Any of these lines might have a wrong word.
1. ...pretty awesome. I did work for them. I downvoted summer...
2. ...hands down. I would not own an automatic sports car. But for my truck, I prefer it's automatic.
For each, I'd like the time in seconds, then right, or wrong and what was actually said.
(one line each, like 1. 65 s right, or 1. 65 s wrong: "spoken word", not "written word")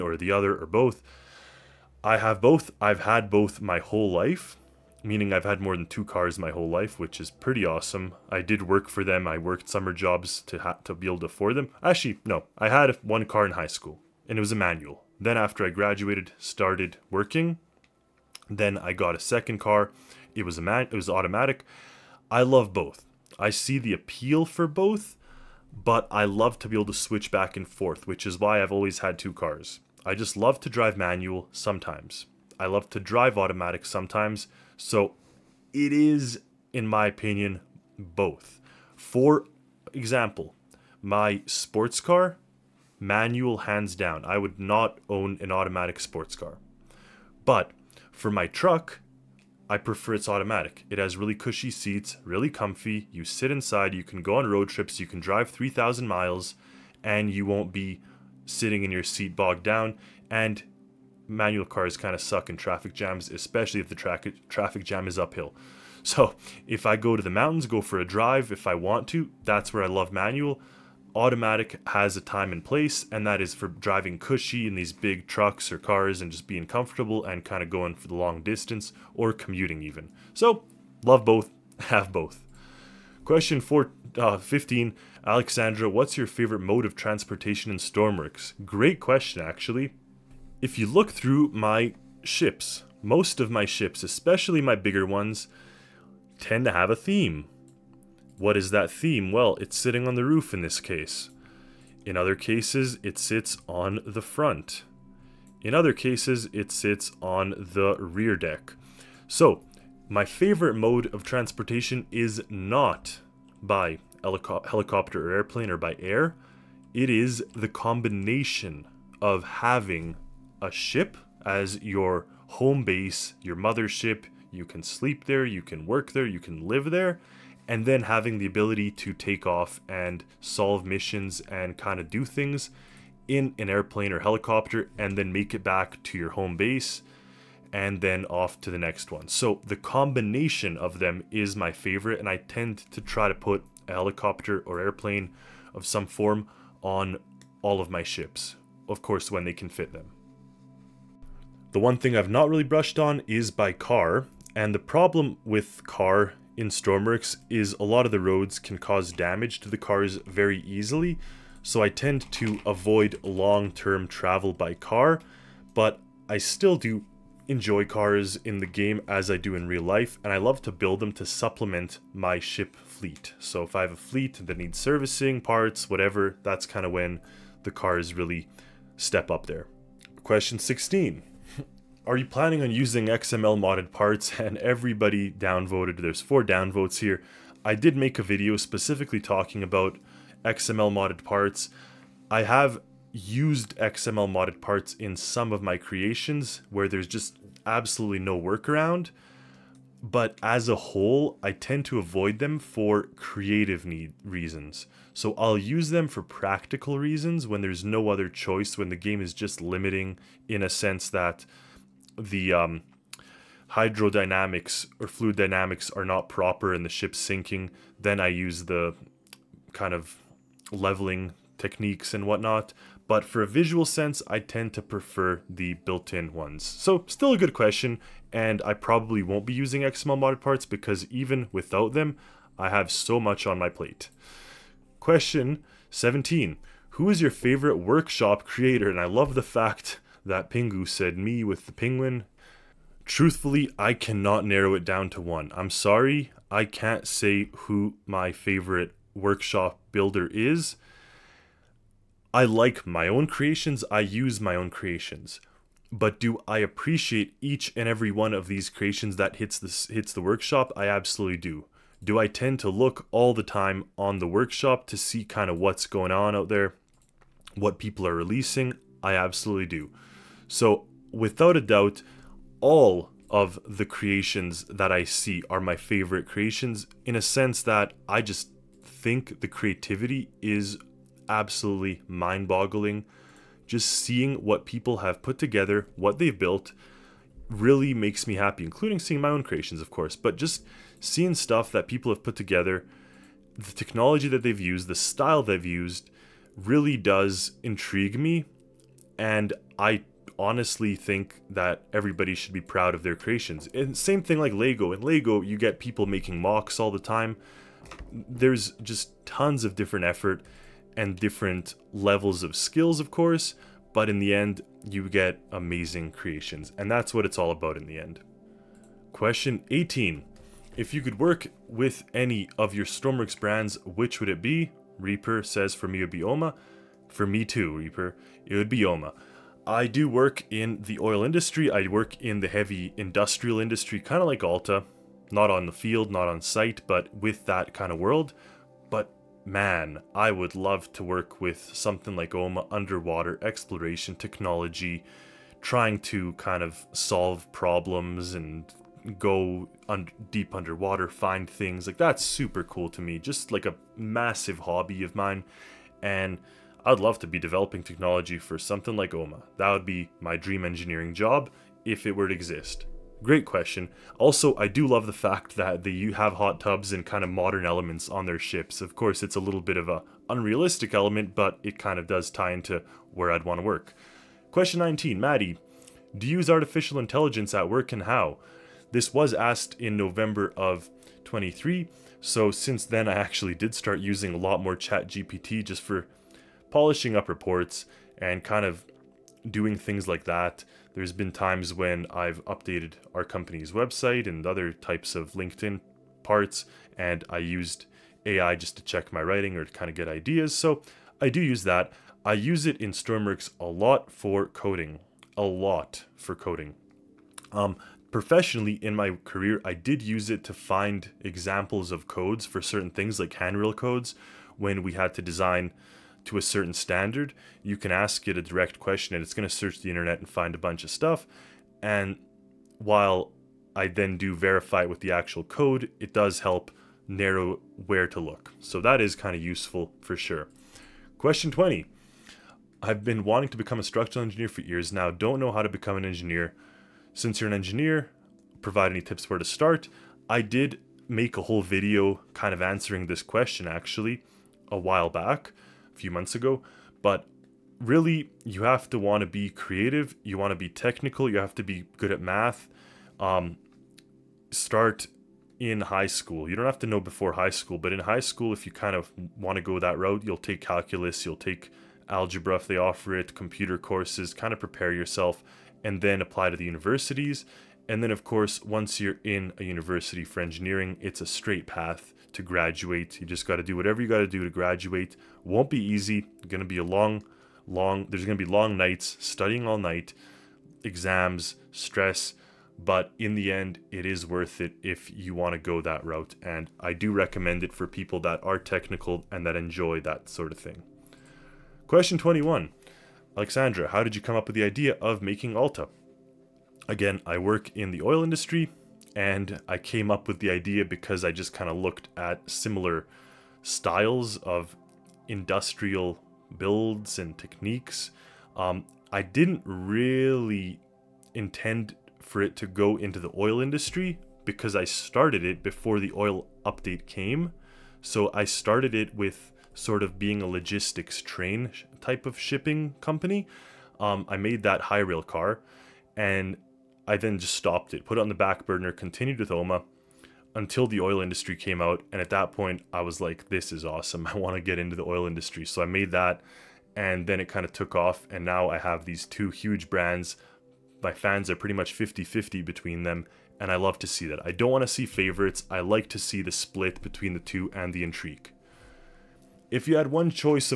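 1. 7 s wrong: "worked", not "downvoted"
2. 43 s right.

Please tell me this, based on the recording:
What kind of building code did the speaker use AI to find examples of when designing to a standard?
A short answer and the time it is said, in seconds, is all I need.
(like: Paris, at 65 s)
Handrail codes, at 413 s.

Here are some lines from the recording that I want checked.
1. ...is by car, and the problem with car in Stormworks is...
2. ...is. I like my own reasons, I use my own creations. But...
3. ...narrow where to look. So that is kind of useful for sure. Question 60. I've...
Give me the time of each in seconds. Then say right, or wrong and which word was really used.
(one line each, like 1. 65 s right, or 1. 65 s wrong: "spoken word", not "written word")
1. 153 s right
2. 250 s wrong: "creations", not "reasons"
3. 427 s wrong: "20", not "60".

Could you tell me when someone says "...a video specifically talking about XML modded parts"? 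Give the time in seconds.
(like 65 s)
188 s.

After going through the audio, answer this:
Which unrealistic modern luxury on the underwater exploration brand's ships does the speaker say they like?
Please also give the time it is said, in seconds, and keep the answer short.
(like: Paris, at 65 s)
Hot tubs, at 366 s.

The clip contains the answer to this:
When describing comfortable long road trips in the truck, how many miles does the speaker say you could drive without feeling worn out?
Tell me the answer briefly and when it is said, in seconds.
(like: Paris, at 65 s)
3,000, at 55 s.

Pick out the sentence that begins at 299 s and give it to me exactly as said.
And I honestly think that everybody should be proud of their creations.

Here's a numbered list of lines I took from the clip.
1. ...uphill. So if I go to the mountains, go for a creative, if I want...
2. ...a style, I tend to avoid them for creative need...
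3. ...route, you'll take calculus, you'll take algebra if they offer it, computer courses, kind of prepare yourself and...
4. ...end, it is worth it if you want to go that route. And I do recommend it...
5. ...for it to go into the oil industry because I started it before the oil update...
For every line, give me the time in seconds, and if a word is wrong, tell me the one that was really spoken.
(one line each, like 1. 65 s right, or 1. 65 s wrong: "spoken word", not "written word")
1. 65 s wrong: "drive", not "creative"
2. 200 s wrong: "whole", not "style"
3. 459 s right
4. 483 s right
5. 512 s right.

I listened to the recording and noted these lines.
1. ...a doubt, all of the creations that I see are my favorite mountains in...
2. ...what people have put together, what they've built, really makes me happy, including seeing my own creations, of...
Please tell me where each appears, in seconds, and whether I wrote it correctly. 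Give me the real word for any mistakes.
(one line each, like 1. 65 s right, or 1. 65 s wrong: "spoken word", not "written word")
1. 271 s wrong: "creations", not "mountains"
2. 284 s right.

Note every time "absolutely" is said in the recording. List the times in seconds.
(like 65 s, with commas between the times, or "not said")
197 s, 260 s, 269 s, 281 s.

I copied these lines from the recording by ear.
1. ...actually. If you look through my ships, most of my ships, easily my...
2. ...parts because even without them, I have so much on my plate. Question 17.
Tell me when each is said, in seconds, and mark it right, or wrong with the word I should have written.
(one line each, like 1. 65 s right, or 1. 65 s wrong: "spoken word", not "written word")
1. 89 s wrong: "especially", not "easily"
2. 230 s right.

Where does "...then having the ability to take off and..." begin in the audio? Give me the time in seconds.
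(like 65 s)
127 s.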